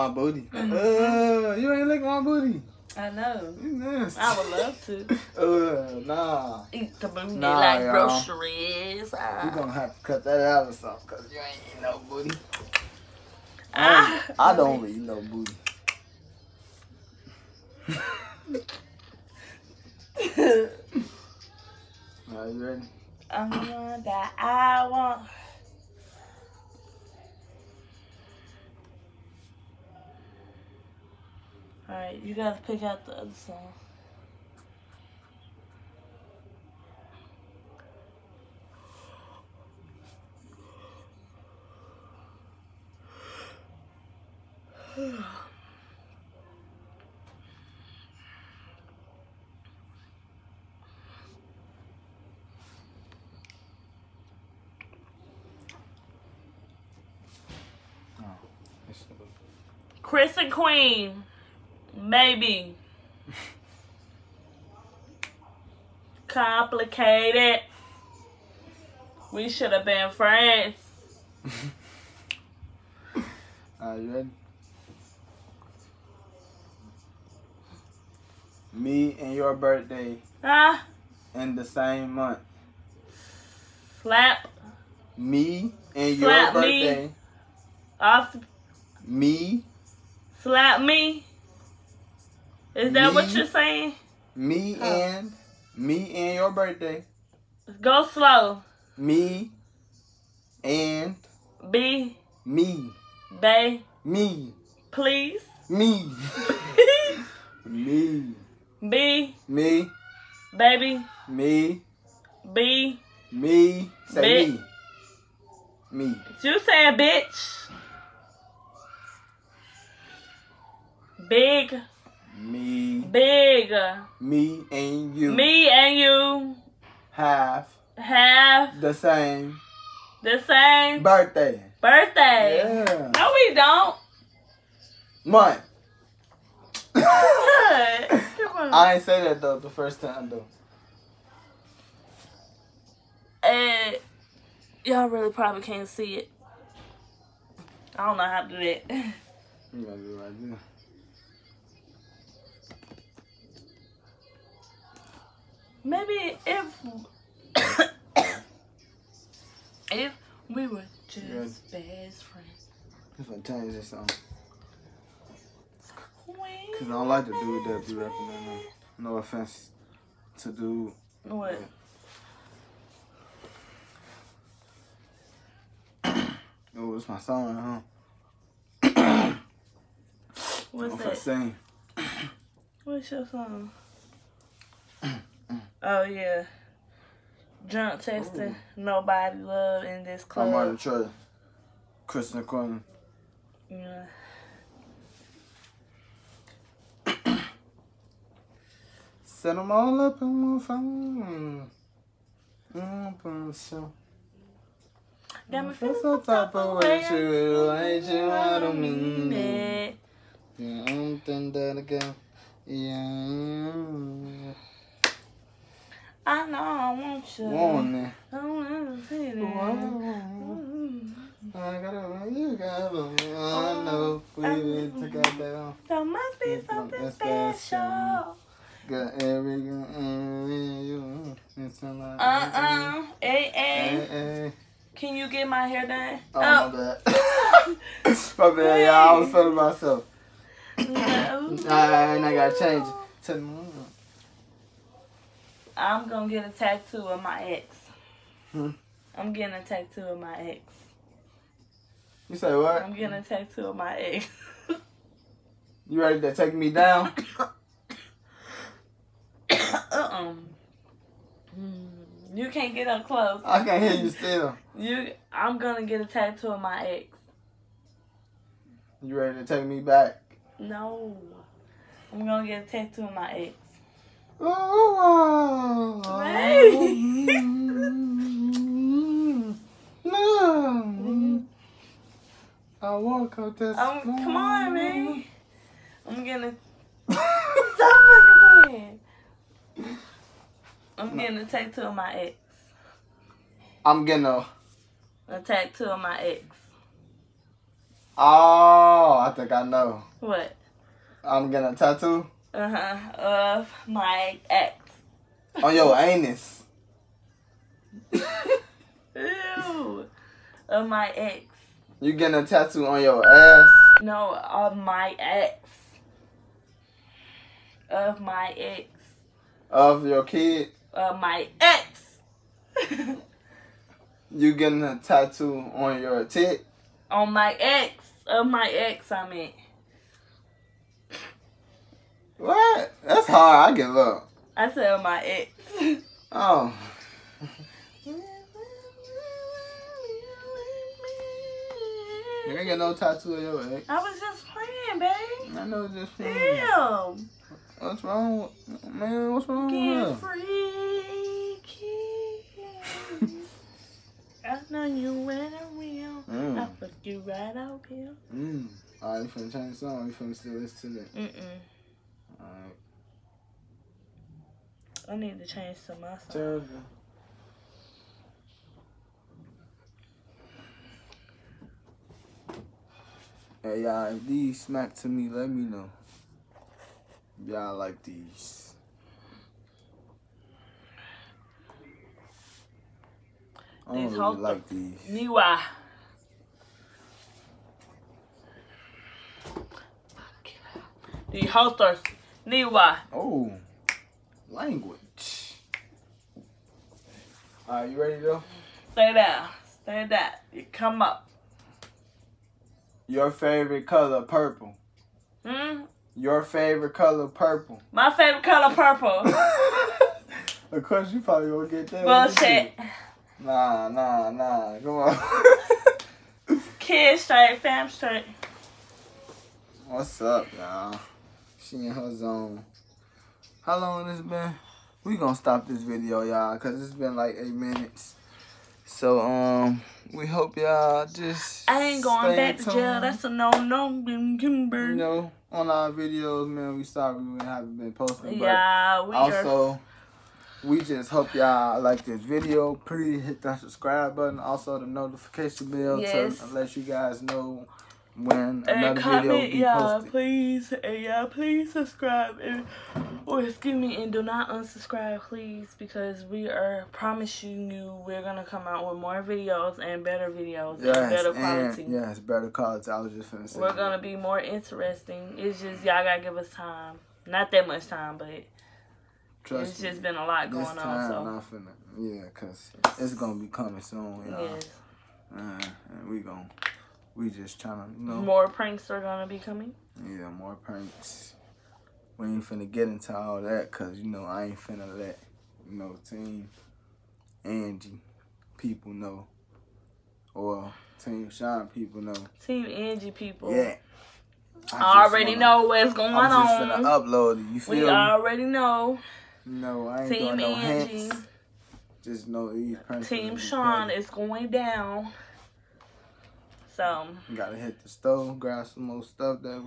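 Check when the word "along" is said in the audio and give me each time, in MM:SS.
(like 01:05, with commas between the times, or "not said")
not said.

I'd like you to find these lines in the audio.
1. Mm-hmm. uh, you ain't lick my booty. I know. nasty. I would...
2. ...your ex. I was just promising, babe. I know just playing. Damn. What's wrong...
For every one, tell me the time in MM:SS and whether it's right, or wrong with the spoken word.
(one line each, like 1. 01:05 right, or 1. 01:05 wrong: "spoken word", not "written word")
1. 00:00 right
2. 05:43 wrong: "playing", not "promising".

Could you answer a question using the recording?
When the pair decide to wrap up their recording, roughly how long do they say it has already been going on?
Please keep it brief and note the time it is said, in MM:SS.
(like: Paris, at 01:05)
8 minutes, at 07:07.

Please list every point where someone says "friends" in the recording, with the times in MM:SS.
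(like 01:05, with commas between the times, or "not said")
01:10, 02:42.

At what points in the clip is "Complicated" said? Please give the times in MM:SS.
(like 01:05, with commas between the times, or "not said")
01:06.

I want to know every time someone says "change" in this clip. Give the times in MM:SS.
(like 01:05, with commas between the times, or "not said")
02:43, 04:02, 05:59, 06:05.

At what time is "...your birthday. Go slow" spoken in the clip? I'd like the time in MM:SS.
01:36.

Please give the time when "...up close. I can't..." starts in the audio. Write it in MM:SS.
04:22.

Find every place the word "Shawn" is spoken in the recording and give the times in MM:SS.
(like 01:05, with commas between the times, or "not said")
08:11, 08:23.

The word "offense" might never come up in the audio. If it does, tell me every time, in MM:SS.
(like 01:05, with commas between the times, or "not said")
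02:49.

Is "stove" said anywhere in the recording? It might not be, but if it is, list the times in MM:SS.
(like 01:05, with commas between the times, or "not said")
08:27.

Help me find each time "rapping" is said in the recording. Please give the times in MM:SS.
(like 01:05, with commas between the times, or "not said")
02:47.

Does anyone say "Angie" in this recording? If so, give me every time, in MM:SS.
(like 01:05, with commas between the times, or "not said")
08:07, 08:12, 08:20.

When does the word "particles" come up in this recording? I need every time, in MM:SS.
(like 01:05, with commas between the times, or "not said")
not said.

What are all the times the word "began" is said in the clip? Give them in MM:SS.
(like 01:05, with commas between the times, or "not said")
not said.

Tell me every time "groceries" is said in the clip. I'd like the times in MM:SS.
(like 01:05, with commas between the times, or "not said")
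00:07.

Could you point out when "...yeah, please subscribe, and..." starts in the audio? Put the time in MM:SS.
07:31.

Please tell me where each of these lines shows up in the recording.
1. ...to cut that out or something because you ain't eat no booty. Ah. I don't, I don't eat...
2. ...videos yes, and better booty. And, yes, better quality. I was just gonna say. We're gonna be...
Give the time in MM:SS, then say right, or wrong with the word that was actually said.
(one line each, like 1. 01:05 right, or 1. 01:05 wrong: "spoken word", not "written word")
1. 00:09 right
2. 07:40 wrong: "quality", not "booty".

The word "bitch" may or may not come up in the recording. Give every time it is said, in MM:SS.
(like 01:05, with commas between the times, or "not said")
01:56.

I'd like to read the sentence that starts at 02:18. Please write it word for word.
I ain't say that though the first time though.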